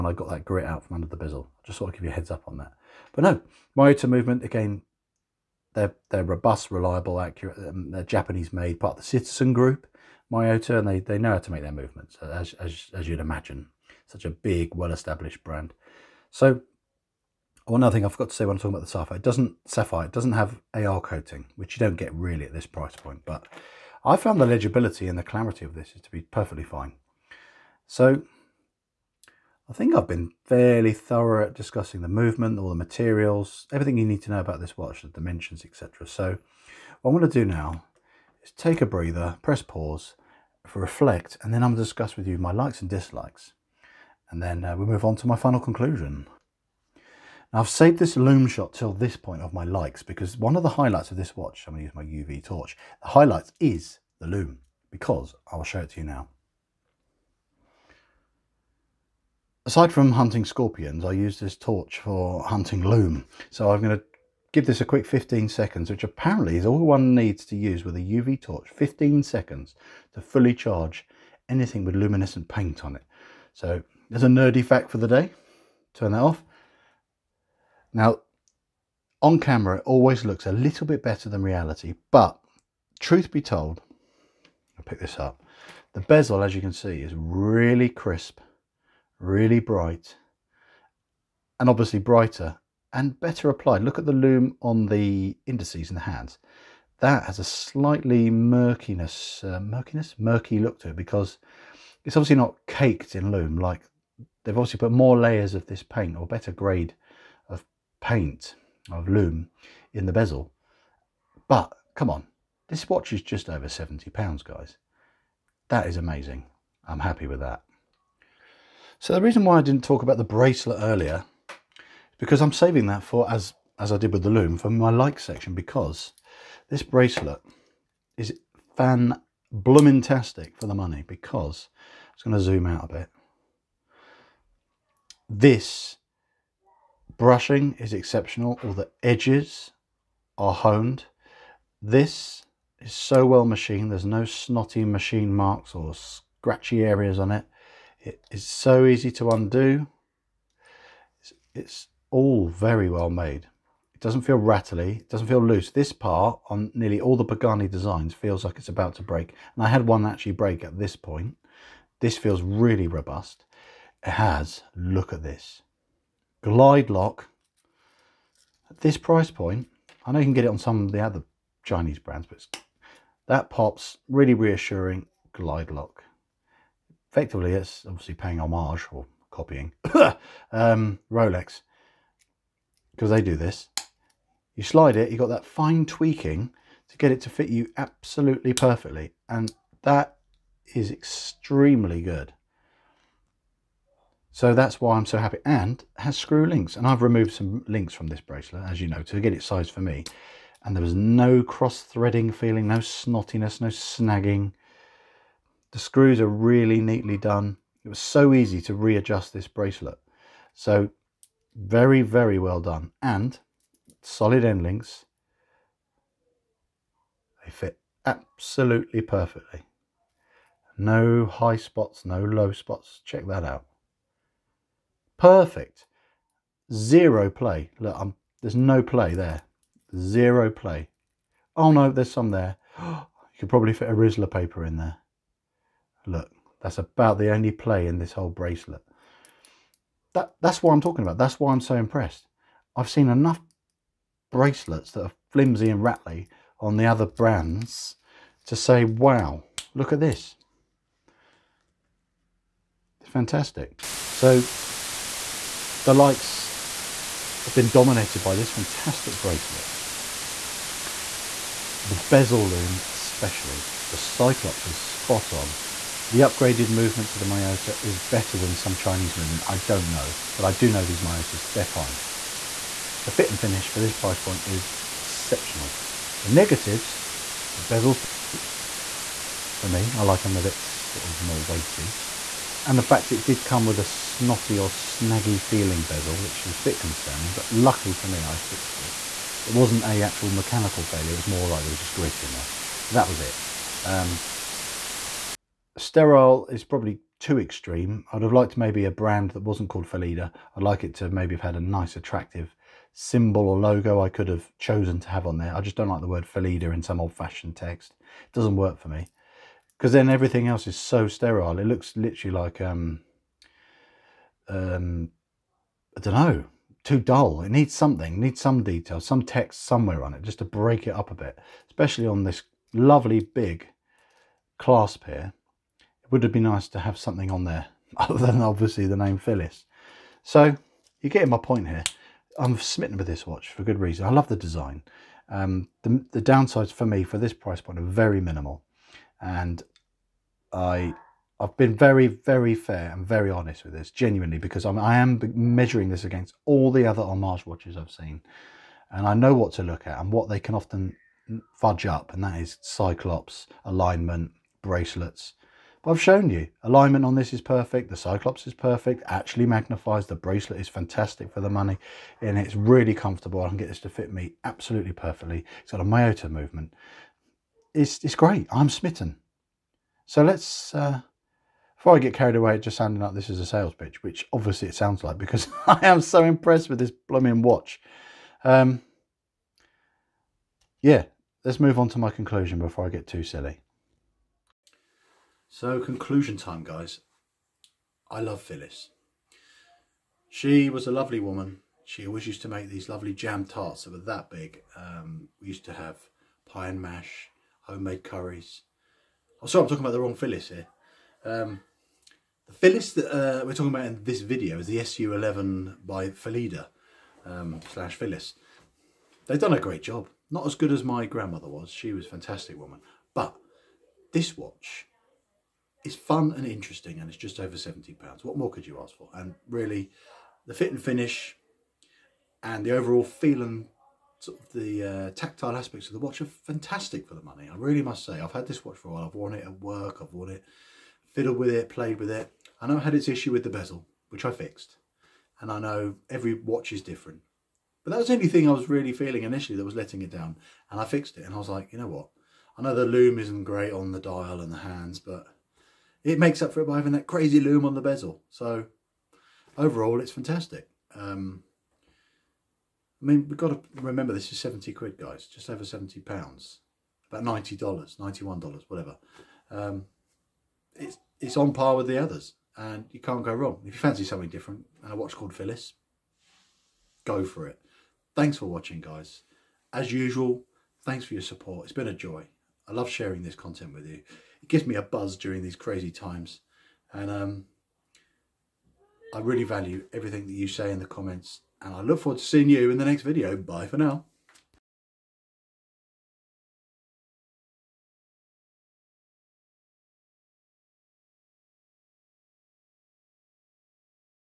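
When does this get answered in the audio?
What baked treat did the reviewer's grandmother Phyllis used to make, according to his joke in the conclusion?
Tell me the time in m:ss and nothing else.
6:33.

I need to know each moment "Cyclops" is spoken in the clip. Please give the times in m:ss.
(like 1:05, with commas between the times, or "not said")
4:23, 5:52, 5:57.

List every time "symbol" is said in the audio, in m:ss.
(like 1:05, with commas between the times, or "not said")
5:02.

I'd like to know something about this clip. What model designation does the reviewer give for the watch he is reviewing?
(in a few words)
SU11.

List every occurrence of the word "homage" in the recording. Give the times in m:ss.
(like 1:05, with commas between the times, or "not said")
2:58, 5:47.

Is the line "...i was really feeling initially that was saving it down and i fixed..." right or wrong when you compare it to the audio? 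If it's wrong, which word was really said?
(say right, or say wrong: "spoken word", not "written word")
wrong: "letting", not "saving".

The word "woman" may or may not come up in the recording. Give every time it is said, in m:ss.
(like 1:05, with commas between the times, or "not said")
6:31, 6:52.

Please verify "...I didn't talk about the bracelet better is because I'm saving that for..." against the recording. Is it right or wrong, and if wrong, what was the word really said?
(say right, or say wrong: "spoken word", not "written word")
wrong: "earlier", not "better".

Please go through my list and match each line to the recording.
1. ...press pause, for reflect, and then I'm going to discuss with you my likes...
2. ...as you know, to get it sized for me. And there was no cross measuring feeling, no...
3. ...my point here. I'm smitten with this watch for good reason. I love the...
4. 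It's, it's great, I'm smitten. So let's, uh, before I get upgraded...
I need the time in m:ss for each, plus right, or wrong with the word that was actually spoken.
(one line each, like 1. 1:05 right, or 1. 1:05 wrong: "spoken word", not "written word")
1. 0:39 right
2. 3:18 wrong: "threading", not "measuring"
3. 5:31 right
4. 6:07 wrong: "carried", not "upgraded".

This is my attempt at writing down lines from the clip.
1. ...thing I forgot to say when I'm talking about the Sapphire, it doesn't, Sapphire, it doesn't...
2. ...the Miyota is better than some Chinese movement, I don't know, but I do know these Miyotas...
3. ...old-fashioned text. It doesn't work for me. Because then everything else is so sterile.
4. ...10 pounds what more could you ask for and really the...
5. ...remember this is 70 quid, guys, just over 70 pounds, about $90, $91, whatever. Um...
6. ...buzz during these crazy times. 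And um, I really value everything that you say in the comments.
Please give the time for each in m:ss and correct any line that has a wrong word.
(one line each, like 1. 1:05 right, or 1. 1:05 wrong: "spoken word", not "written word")
1. 0:17 right
2. 4:27 right
3. 5:06 right
4. 6:57 wrong: "70", not "10"
5. 7:33 right
6. 7:54 right.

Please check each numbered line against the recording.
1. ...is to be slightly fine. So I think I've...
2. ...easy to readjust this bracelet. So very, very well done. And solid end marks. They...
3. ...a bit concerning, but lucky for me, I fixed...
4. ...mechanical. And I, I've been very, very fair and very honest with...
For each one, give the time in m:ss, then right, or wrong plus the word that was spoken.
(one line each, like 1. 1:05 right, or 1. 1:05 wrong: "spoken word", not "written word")
1. 0:25 wrong: "perfectly", not "slightly"
2. 3:28 wrong: "links", not "marks"
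3. 4:46 right
4. 5:38 wrong: "minimal", not "mechanical".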